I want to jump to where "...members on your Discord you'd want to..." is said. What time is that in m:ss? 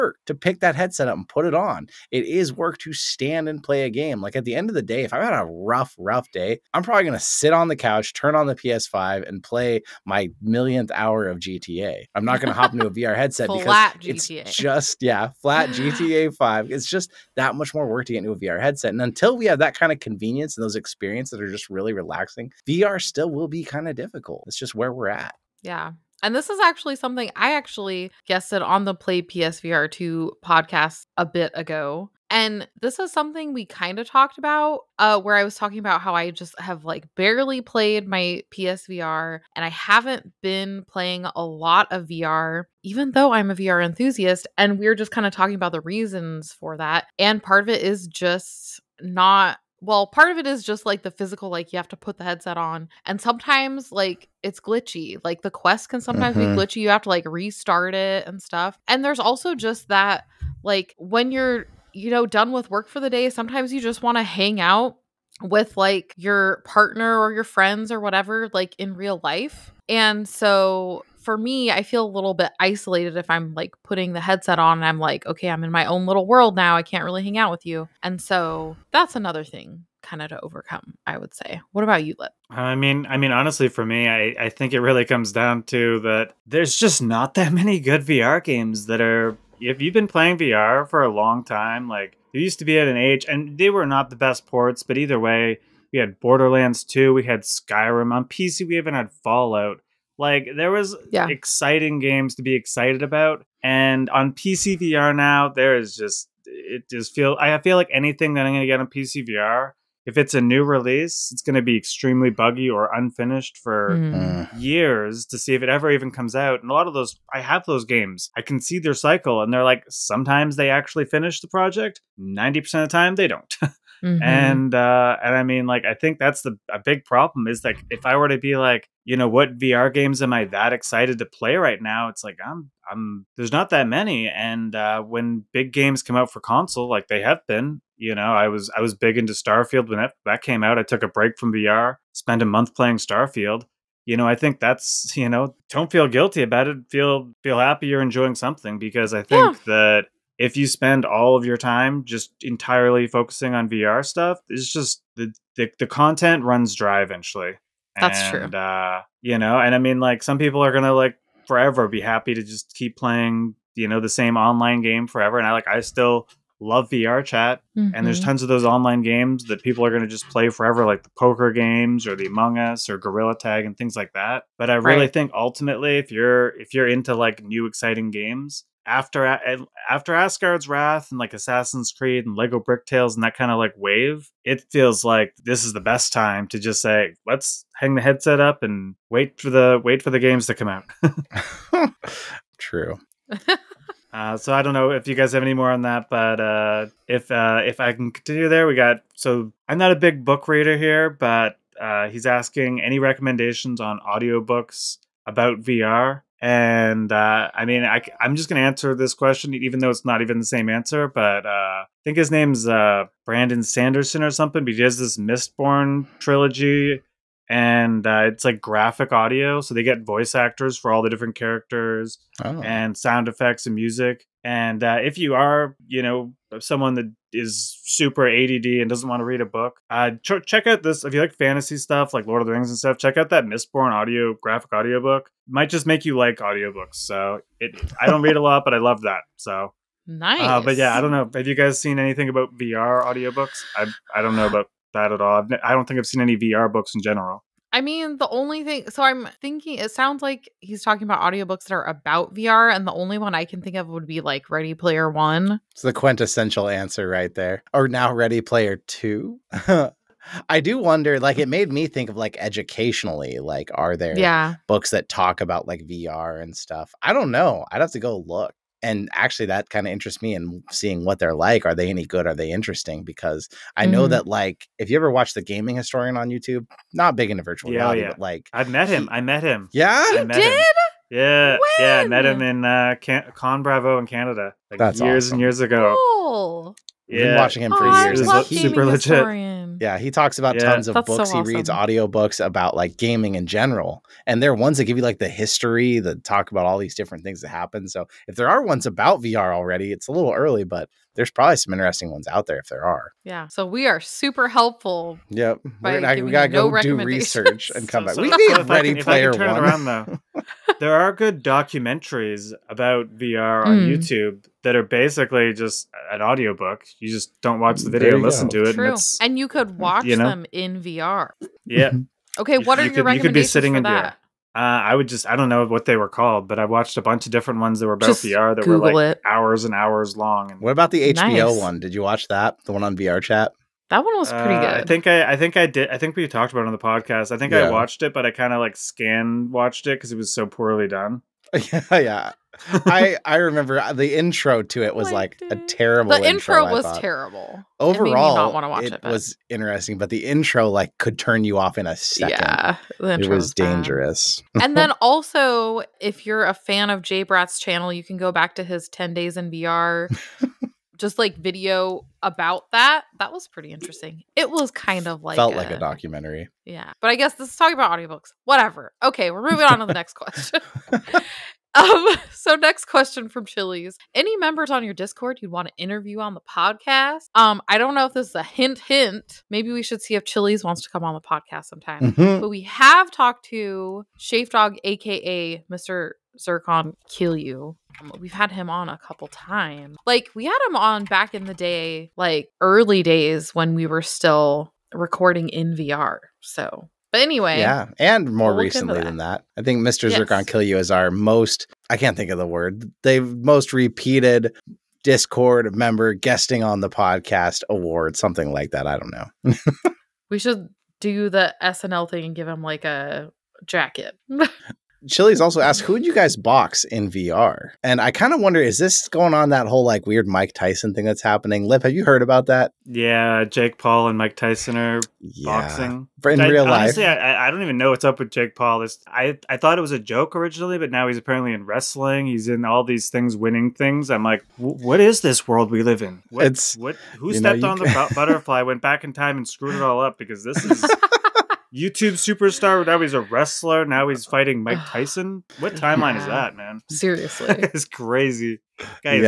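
6:14.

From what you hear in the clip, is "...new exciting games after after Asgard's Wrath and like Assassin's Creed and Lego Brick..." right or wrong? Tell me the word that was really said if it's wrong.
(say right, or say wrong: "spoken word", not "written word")
right.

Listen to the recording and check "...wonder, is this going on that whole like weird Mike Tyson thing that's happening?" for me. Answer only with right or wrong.
right.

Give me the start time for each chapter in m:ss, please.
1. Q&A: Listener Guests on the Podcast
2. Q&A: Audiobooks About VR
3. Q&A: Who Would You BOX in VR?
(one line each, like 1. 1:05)
1. 6:13
2. 3:22
3. 6:54.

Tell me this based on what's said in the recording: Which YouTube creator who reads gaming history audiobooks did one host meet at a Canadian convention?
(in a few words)
The Gaming Historian.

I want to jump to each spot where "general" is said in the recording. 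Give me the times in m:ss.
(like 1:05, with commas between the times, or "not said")
4:07, 4:53.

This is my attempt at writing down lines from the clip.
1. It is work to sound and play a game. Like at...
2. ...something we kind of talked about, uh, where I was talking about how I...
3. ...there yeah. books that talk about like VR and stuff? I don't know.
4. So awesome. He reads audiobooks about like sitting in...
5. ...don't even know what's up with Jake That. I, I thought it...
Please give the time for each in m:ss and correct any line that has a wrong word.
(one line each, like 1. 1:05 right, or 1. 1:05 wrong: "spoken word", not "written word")
1. 0:02 wrong: "stand", not "sound"
2. 0:33 right
3. 4:23 right
4. 4:51 wrong: "gaming", not "sitting"
5. 7:07 wrong: "Paul", not "That".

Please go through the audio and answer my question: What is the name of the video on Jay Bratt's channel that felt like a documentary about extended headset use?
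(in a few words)
Ten Days in VR.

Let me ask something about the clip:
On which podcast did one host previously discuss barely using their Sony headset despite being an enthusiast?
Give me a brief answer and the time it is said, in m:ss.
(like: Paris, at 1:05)
Play PSVR 2 podcast, at 0:28.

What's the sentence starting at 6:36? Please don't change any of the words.
So, but anyway, yeah, and more we'll recently that.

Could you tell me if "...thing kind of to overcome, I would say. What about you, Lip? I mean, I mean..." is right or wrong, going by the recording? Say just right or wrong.
right.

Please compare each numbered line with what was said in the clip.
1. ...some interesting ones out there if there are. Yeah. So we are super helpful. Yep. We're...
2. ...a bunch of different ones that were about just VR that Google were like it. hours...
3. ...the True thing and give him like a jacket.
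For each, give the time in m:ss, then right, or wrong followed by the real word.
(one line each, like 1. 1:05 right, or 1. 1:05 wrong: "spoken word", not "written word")
1. 5:01 right
2. 5:26 right
3. 6:51 wrong: "SNL", not "True".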